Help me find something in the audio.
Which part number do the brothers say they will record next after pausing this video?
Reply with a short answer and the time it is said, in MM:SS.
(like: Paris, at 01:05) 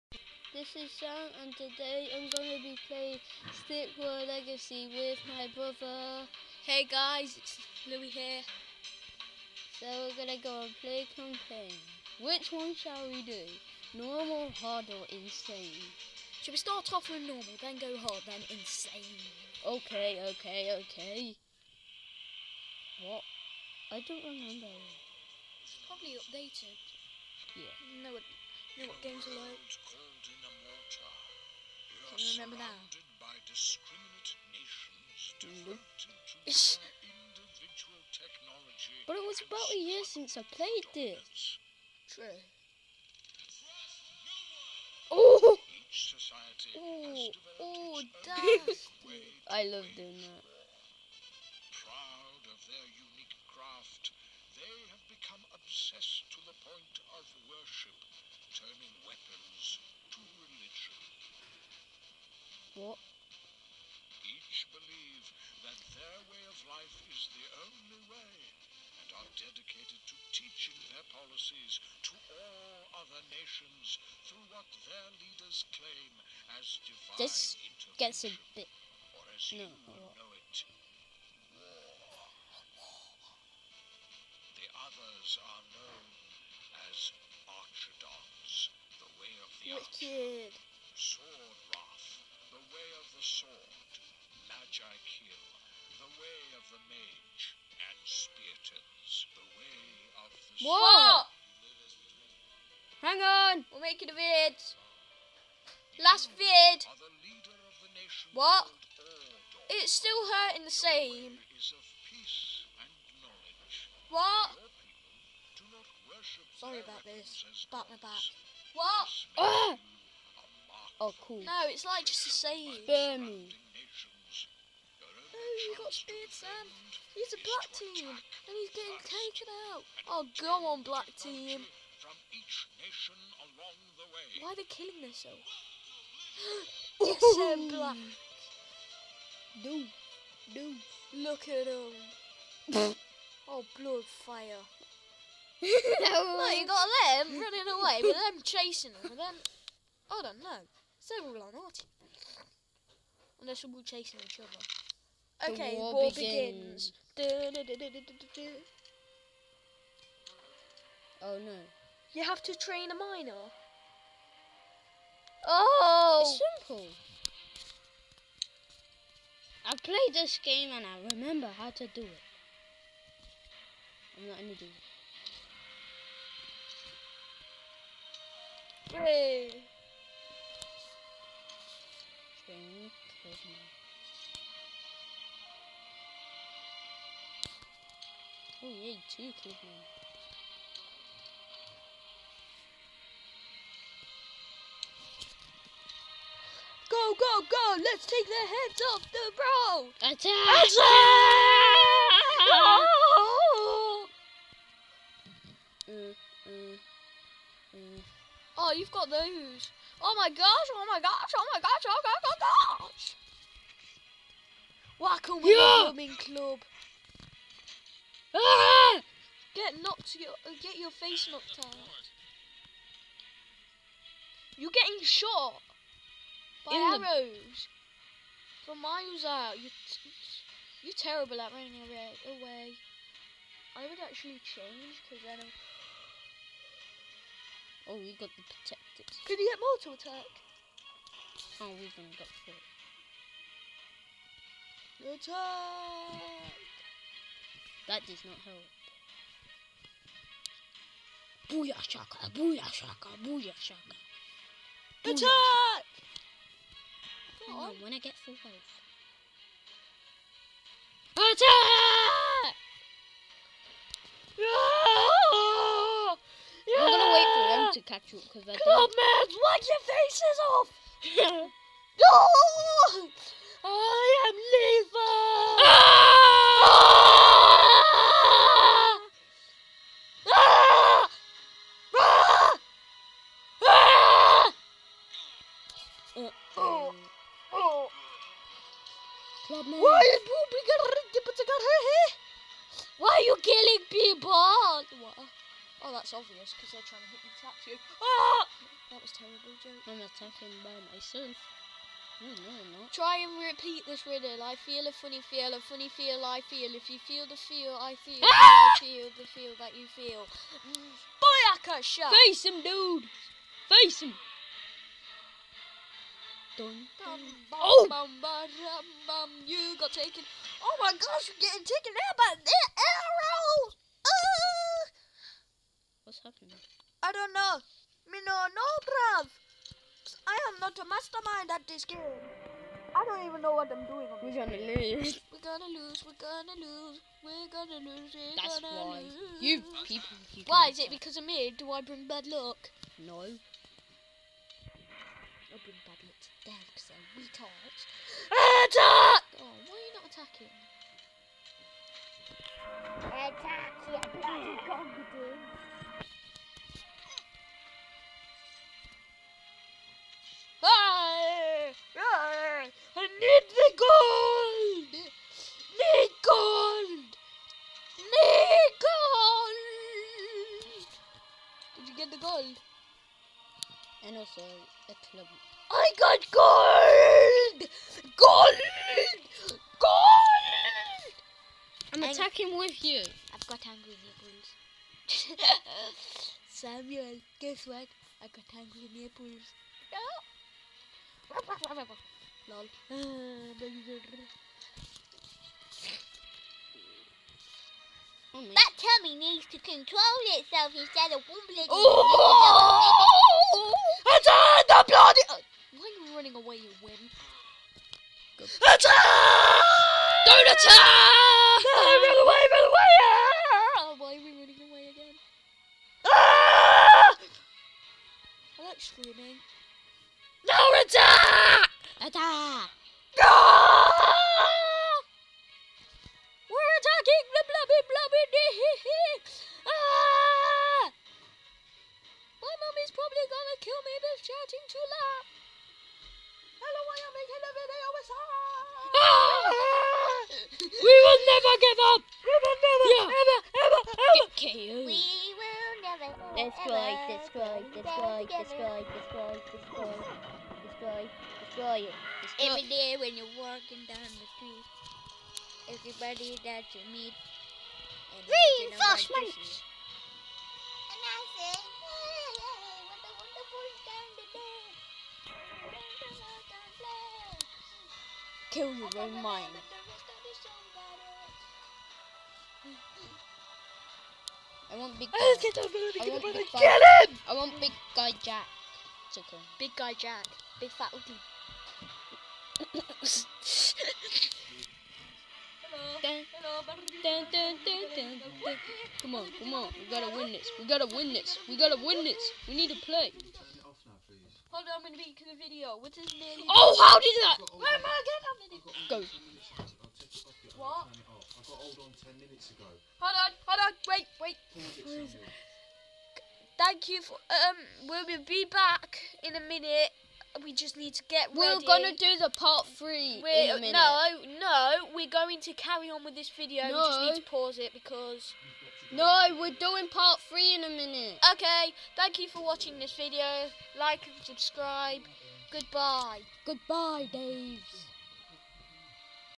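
3, at 08:32.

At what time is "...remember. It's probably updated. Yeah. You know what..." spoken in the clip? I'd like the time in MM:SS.
00:24.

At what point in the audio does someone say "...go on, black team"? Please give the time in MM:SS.
02:10.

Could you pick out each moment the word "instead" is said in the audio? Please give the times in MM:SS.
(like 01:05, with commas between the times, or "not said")
06:40.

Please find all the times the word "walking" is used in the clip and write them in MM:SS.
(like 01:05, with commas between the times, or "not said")
07:33.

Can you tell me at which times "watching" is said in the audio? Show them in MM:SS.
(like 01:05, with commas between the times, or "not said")
08:42.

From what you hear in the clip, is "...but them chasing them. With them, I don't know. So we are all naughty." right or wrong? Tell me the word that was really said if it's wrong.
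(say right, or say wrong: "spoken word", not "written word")
right.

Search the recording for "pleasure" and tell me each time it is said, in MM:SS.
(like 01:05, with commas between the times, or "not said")
not said.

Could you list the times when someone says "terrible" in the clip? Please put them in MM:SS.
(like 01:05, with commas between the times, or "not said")
03:50, 04:59.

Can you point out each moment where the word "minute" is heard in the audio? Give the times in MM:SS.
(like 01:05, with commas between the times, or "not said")
08:22, 08:29, 08:33, 08:40.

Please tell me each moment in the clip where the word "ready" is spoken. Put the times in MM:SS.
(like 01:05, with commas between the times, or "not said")
08:31.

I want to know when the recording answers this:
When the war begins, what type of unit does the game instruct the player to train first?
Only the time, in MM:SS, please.
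02:42.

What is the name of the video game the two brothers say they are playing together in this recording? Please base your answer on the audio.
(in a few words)
Stick War Legacy.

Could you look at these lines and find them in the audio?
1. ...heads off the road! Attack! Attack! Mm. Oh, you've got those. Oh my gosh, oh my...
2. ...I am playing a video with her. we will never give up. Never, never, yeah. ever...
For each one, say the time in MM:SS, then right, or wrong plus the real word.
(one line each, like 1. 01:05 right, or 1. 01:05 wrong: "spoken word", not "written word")
1. 03:18 right
2. 07:16 wrong: "making", not "playing".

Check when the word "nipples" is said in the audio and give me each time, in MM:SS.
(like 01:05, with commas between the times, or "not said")
06:23, 06:28.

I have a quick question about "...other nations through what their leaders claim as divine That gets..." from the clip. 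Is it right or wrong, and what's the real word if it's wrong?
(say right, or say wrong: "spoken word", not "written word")
wrong: "This", not "That".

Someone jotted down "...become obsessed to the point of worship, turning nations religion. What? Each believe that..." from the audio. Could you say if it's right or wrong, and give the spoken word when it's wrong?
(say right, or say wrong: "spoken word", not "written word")
wrong: "weapons", not "nations".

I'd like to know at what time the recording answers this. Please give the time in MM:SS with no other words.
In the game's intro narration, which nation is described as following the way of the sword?
01:30.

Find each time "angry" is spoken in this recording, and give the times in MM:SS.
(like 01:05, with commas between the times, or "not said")
06:23, 06:28.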